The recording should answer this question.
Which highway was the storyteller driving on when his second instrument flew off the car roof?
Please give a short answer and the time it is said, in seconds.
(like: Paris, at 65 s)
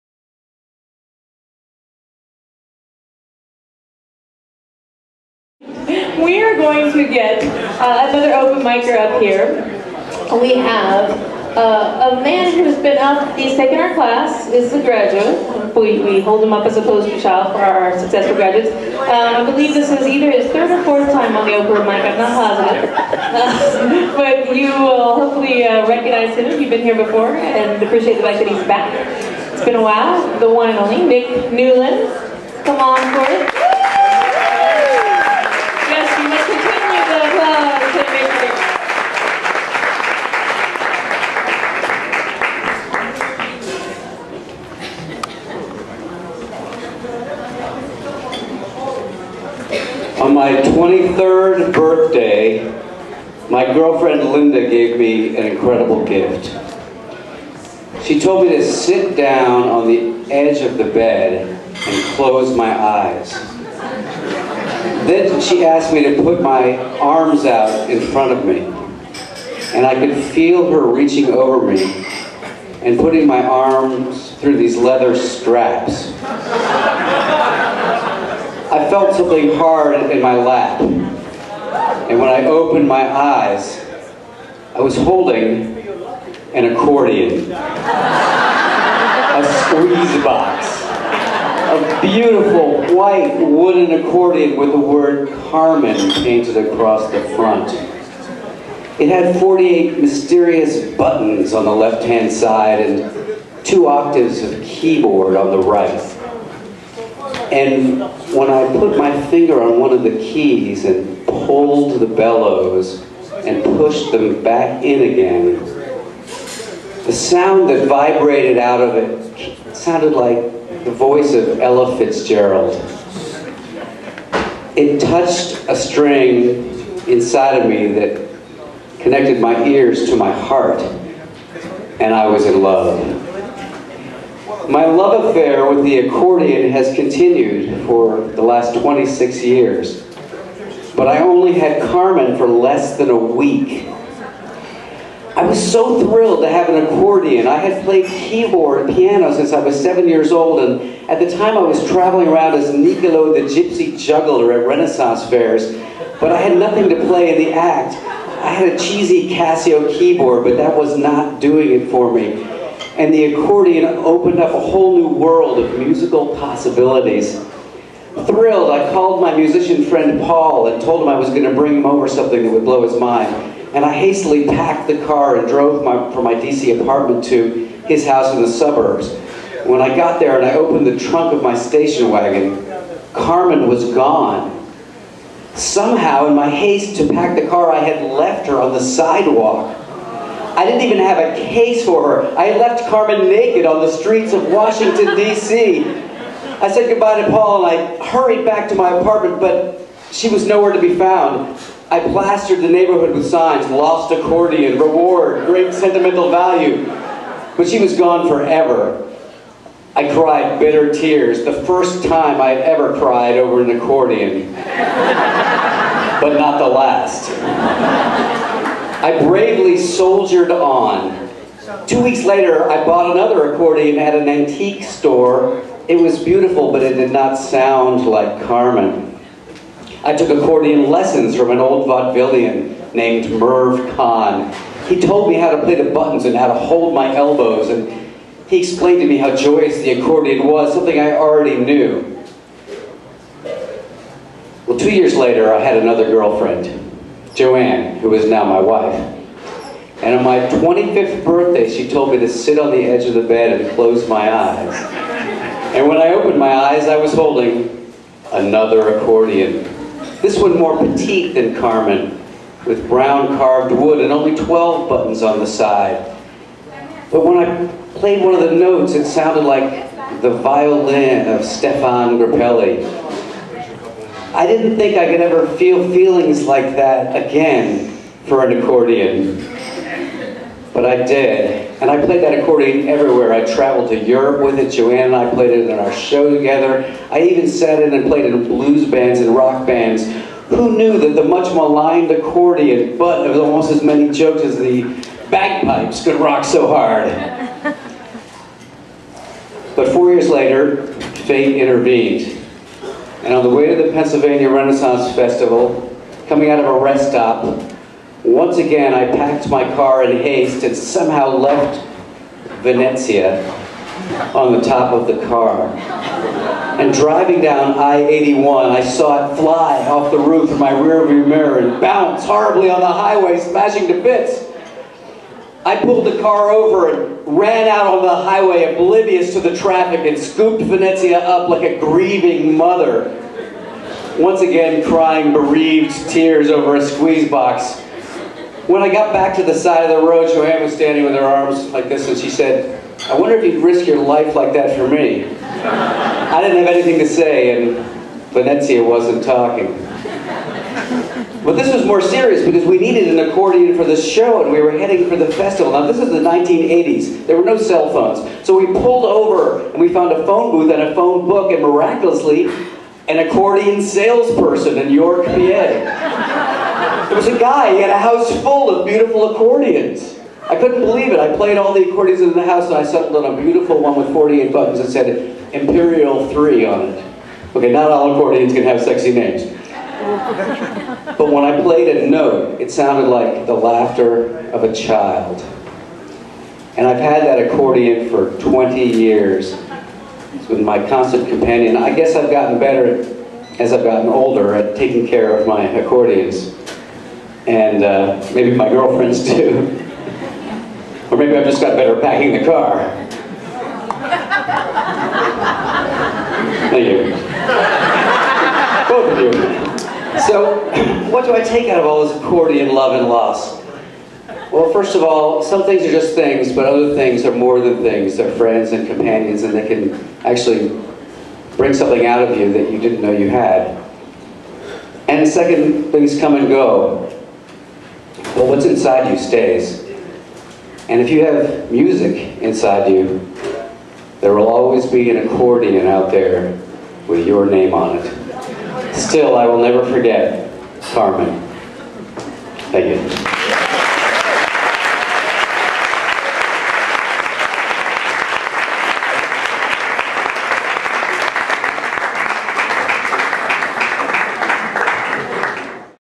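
I-81, at 317 s.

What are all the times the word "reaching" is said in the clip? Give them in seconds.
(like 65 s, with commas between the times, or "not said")
70 s.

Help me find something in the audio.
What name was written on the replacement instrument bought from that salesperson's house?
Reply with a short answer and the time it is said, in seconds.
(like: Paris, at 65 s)
Imperial 3, at 375 s.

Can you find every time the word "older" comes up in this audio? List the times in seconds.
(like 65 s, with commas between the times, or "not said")
394 s.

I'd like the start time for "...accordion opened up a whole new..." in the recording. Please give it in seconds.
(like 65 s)
163 s.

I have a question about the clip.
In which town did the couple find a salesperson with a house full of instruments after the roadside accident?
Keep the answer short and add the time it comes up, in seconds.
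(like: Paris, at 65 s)
York, PA, at 364 s.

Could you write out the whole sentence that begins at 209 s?
I cried bitter tears, the first time I had ever cried over an accordion.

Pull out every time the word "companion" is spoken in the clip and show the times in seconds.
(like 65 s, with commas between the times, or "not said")
391 s, 418 s.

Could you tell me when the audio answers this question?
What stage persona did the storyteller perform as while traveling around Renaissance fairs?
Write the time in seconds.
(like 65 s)
152 s.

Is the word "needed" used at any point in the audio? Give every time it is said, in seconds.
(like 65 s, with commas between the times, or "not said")
352 s.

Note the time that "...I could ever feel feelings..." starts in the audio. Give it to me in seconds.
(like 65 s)
274 s.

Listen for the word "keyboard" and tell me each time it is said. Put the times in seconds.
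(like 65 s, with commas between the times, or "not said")
104 s, 148 s, 159 s.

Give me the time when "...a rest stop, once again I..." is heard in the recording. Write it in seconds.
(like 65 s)
306 s.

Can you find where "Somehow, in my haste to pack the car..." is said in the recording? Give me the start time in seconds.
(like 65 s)
185 s.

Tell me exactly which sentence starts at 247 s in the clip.
Joanne, who is now my wife.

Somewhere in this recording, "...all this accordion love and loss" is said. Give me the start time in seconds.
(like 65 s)
411 s.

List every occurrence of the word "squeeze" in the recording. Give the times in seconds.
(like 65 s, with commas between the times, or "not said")
89 s, 336 s.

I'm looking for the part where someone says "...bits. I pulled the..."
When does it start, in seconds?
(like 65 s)
324 s.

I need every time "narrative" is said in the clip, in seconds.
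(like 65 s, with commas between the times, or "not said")
not said.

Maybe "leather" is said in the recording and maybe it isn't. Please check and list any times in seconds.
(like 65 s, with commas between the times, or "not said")
74 s.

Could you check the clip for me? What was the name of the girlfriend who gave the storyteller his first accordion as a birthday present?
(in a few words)
Linda.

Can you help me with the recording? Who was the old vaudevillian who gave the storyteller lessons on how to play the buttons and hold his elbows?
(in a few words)
Merv Kahn.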